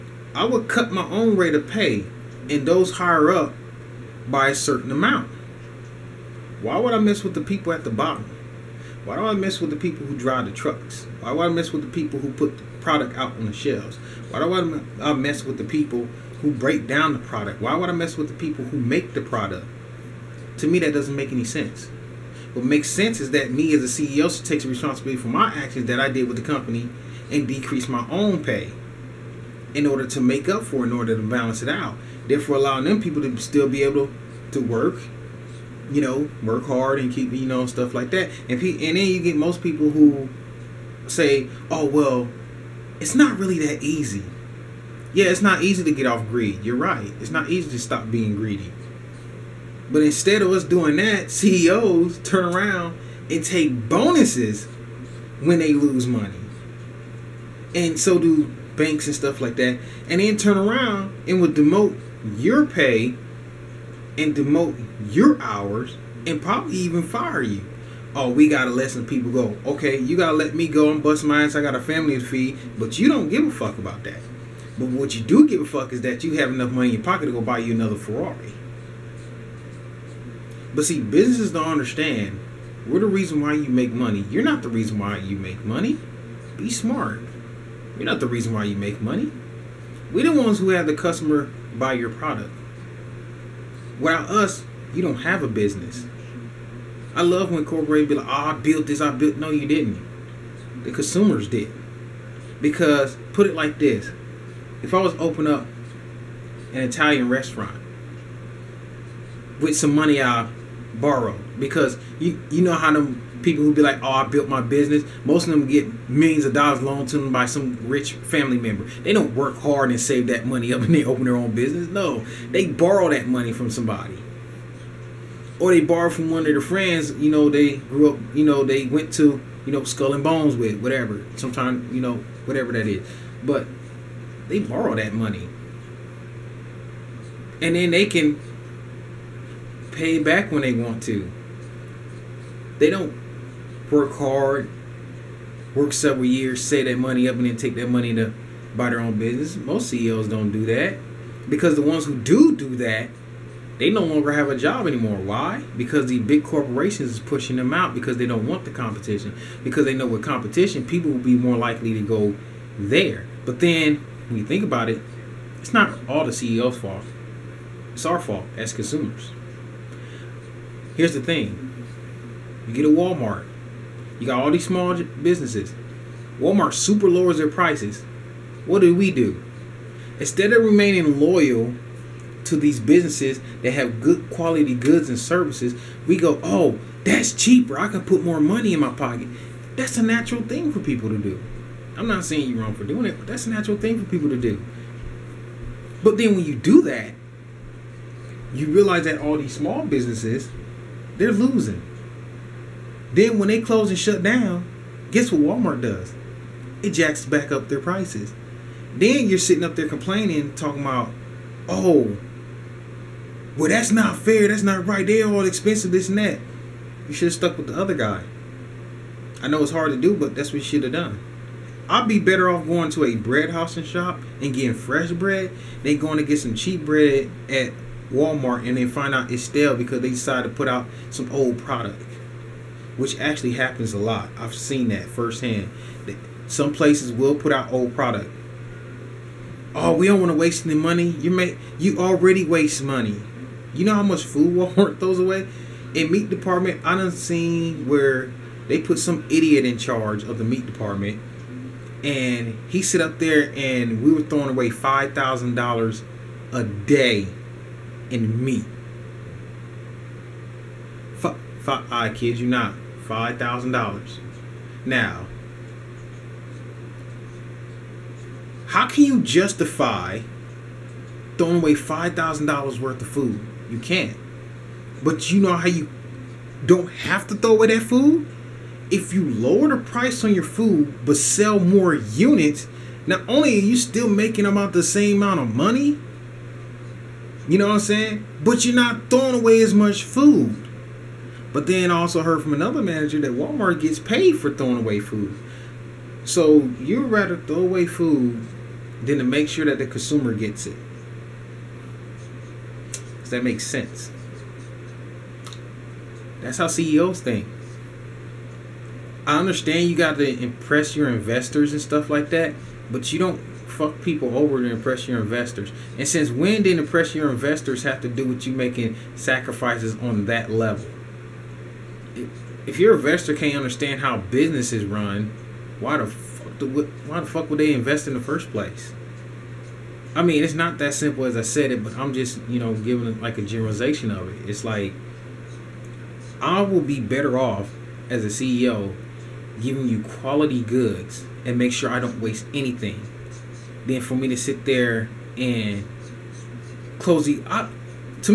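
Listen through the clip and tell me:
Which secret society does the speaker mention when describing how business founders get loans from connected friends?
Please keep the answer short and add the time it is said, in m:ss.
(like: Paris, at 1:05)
Skull and Bones, at 2:09.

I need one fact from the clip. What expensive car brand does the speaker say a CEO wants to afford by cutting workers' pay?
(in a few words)
Ferrari.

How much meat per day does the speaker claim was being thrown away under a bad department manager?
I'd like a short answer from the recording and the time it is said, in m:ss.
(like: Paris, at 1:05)
$5,000, at 4:14.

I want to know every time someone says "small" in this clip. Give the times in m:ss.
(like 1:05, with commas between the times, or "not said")
2:54, 3:19.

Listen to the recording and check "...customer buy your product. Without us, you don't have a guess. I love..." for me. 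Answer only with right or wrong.
wrong.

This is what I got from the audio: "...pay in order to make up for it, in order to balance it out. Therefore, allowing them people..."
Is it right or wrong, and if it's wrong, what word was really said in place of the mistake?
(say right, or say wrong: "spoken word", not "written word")
right.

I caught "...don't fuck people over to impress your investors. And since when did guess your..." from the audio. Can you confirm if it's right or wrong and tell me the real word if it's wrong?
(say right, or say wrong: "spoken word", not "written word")
wrong: "impress", not "guess".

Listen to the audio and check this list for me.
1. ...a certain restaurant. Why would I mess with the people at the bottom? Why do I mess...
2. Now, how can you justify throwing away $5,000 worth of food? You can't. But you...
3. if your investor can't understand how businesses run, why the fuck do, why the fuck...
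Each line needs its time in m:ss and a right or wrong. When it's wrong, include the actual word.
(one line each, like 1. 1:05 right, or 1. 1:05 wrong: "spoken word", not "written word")
1. 0:04 wrong: "amount", not "restaurant"
2. 4:24 right
3. 5:22 right.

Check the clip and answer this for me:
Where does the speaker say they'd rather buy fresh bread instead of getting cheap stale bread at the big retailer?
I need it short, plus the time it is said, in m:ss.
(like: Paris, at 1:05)
a bread house, at 3:43.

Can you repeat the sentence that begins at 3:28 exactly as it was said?
Then you're sitting up there complaining, talking about, oh, well, that's not fair.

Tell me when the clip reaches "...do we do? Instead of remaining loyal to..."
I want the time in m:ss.
2:58.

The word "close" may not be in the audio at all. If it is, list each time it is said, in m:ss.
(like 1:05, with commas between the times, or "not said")
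3:23, 5:46.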